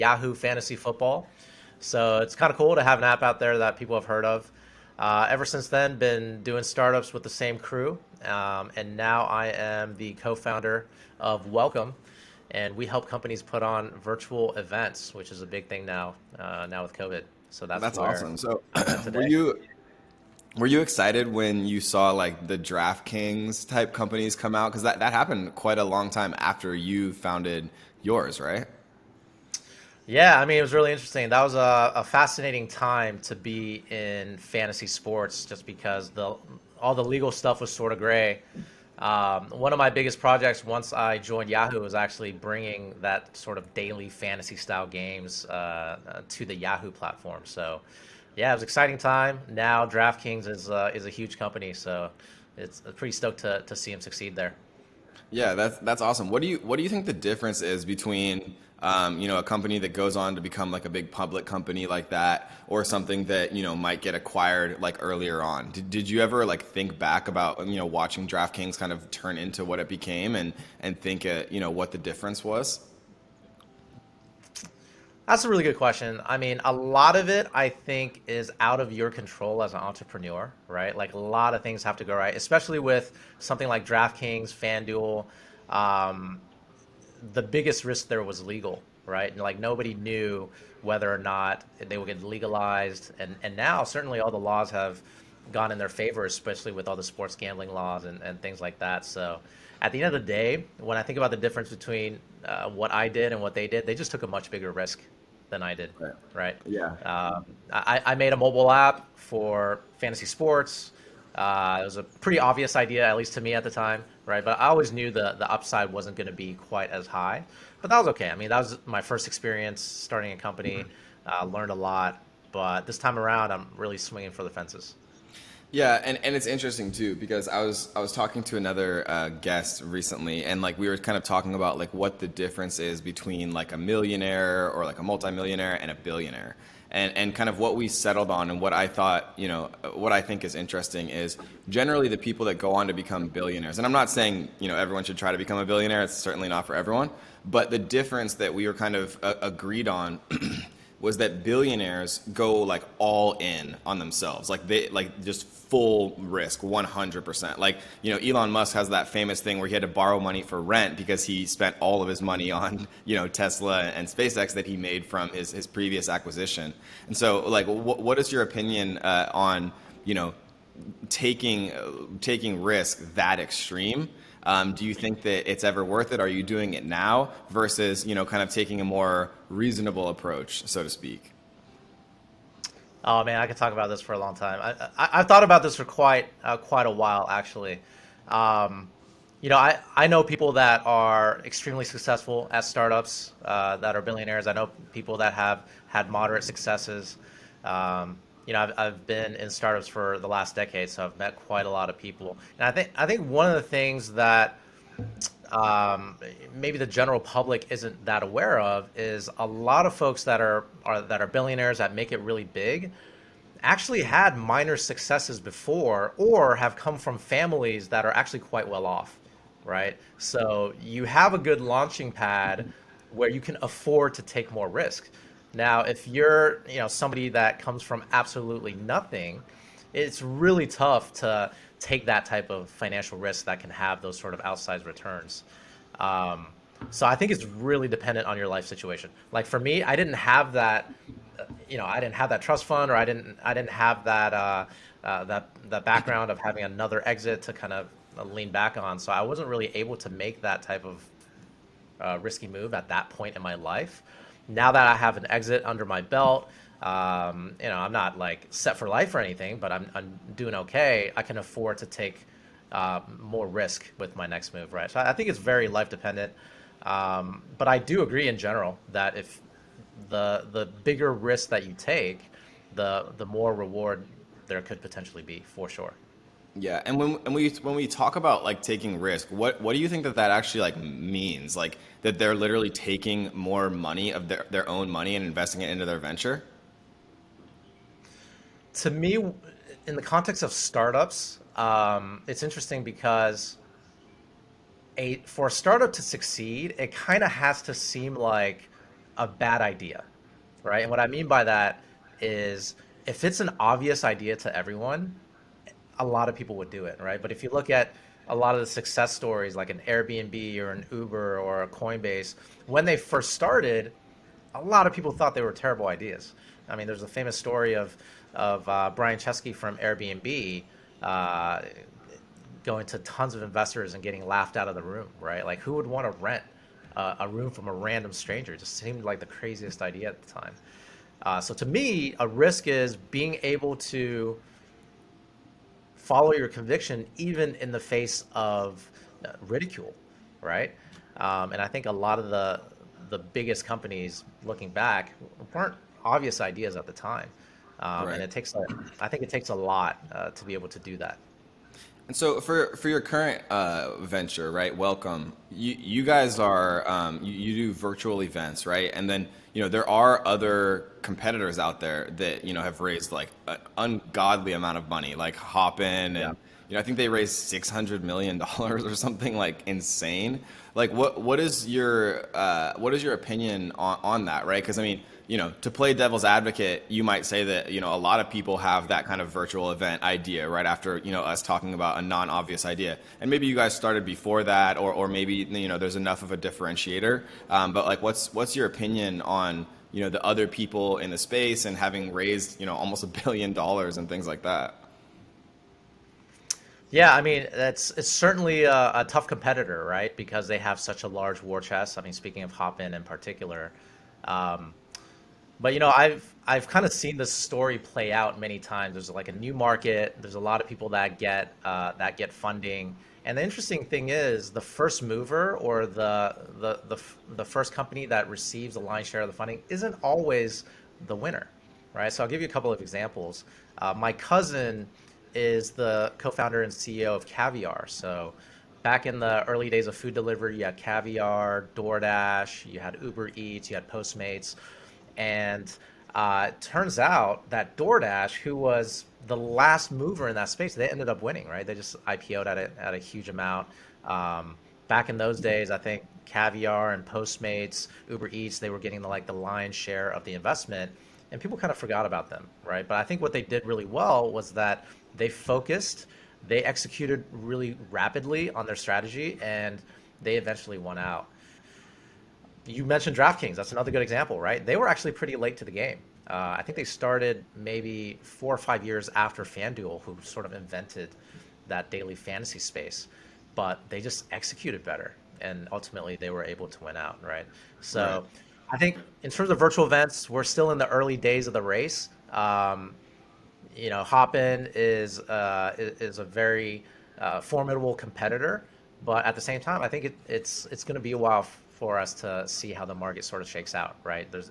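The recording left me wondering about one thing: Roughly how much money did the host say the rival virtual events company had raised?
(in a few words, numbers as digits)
$600 million.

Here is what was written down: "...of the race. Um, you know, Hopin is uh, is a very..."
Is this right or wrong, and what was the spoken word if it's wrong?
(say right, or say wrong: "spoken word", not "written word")
right.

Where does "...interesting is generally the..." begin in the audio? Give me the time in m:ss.
2:20.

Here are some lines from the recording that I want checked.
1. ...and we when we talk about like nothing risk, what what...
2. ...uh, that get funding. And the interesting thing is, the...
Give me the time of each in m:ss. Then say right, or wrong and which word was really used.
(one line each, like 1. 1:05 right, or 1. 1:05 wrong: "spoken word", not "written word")
1. 4:37 wrong: "taking", not "nothing"
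2. 6:51 right.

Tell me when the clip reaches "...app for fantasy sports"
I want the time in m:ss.
1:48.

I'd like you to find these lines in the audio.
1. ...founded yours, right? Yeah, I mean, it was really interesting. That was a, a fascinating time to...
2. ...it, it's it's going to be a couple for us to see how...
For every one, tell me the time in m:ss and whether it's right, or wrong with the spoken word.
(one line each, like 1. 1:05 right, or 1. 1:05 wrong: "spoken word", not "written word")
1. 0:27 right
2. 8:10 wrong: "while", not "couple".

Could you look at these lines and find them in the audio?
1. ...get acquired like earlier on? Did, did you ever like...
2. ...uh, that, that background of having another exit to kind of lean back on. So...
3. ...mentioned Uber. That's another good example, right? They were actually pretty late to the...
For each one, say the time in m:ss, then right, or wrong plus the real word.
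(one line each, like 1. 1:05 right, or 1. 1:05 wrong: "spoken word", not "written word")
1. 1:04 right
2. 4:05 right
3. 7:42 wrong: "DraftKings", not "Uber".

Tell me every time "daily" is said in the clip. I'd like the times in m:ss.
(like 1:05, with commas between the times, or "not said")
0:43, 7:51.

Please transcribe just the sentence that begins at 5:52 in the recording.
And so for for your current uh, venture, right?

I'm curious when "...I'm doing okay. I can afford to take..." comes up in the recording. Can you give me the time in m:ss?
4:19.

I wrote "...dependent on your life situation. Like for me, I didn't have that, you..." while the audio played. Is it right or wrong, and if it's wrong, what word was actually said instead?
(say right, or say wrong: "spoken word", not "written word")
right.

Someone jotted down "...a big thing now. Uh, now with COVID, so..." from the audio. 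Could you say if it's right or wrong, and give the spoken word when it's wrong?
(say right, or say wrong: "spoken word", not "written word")
right.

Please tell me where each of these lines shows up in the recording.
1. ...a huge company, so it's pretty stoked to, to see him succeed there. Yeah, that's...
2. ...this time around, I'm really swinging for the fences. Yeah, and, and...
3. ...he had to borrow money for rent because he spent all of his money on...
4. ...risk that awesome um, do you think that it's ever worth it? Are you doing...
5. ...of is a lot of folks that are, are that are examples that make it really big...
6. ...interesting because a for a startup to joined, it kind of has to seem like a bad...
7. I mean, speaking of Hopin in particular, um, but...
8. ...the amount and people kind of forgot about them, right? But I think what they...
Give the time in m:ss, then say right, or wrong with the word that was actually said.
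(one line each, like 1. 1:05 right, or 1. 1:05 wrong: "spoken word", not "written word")
1. 0:51 right
2. 2:02 right
3. 2:39 right
4. 2:52 wrong: "extreme", not "awesome"
5. 3:28 wrong: "billionaires", not "examples"
6. 4:52 wrong: "succeed", not "joined"
7. 6:41 right
8. 7:30 wrong: "investment", not "amount".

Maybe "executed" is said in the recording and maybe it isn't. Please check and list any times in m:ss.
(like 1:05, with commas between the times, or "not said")
7:36, 7:54.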